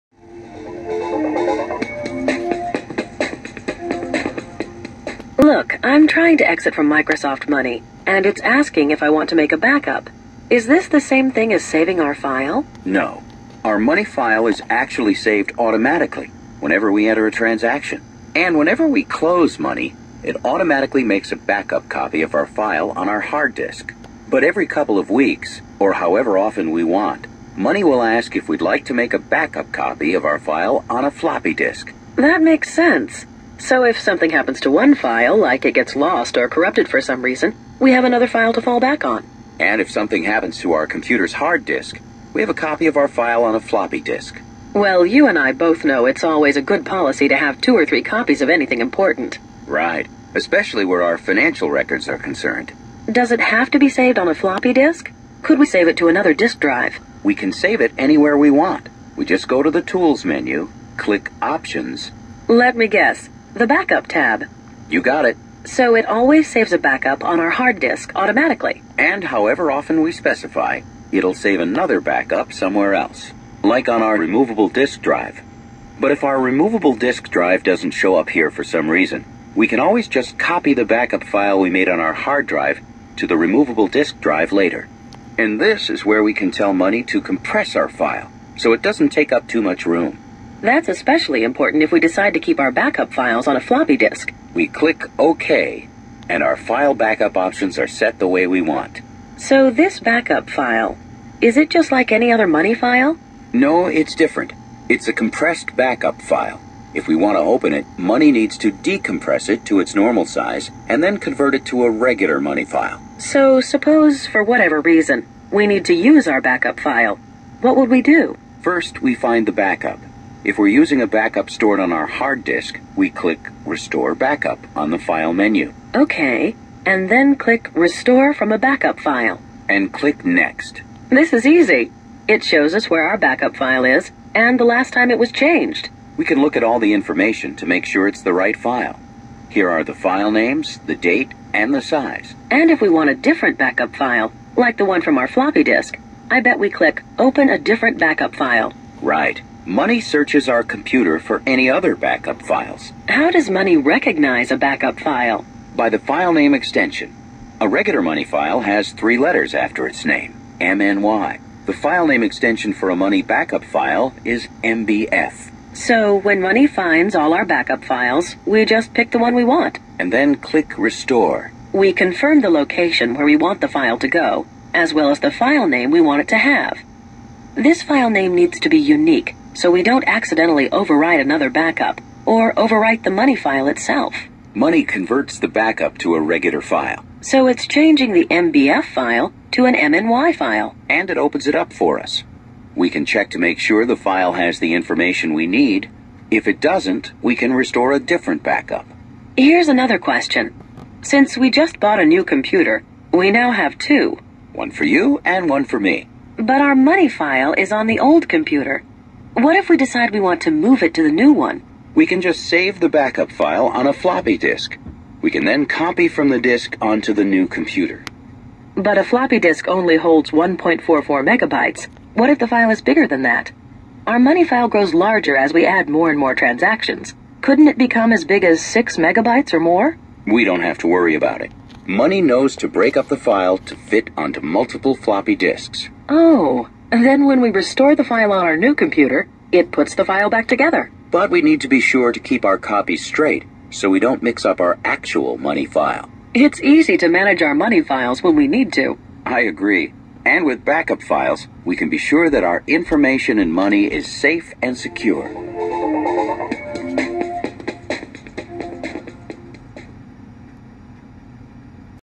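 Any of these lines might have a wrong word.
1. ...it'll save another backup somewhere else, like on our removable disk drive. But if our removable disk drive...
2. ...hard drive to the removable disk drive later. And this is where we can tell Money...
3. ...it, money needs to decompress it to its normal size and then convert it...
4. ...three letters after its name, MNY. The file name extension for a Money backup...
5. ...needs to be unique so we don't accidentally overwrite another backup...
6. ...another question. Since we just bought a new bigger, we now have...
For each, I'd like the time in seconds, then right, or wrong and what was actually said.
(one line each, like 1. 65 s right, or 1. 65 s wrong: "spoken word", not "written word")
1. 71 s right
2. 82 s right
3. 107 s right
4. 158 s right
5. 178 s right
6. 199 s wrong: "computer", not "bigger".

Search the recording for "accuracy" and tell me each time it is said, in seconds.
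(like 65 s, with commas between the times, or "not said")
not said.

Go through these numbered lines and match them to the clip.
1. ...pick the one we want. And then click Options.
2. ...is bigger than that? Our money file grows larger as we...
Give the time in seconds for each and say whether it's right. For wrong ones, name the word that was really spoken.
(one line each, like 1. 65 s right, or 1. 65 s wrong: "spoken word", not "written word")
1. 168 s wrong: "Restore", not "Options"
2. 222 s right.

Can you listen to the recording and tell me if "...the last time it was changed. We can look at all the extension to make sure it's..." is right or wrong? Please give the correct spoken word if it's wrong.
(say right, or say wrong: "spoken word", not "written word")
wrong: "information", not "extension".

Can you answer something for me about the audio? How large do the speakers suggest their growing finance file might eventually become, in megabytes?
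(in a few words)
6 megabytes.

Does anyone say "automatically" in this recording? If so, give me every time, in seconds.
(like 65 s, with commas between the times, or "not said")
15 s, 20 s, 68 s.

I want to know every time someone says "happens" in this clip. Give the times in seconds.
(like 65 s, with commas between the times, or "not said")
34 s, 40 s.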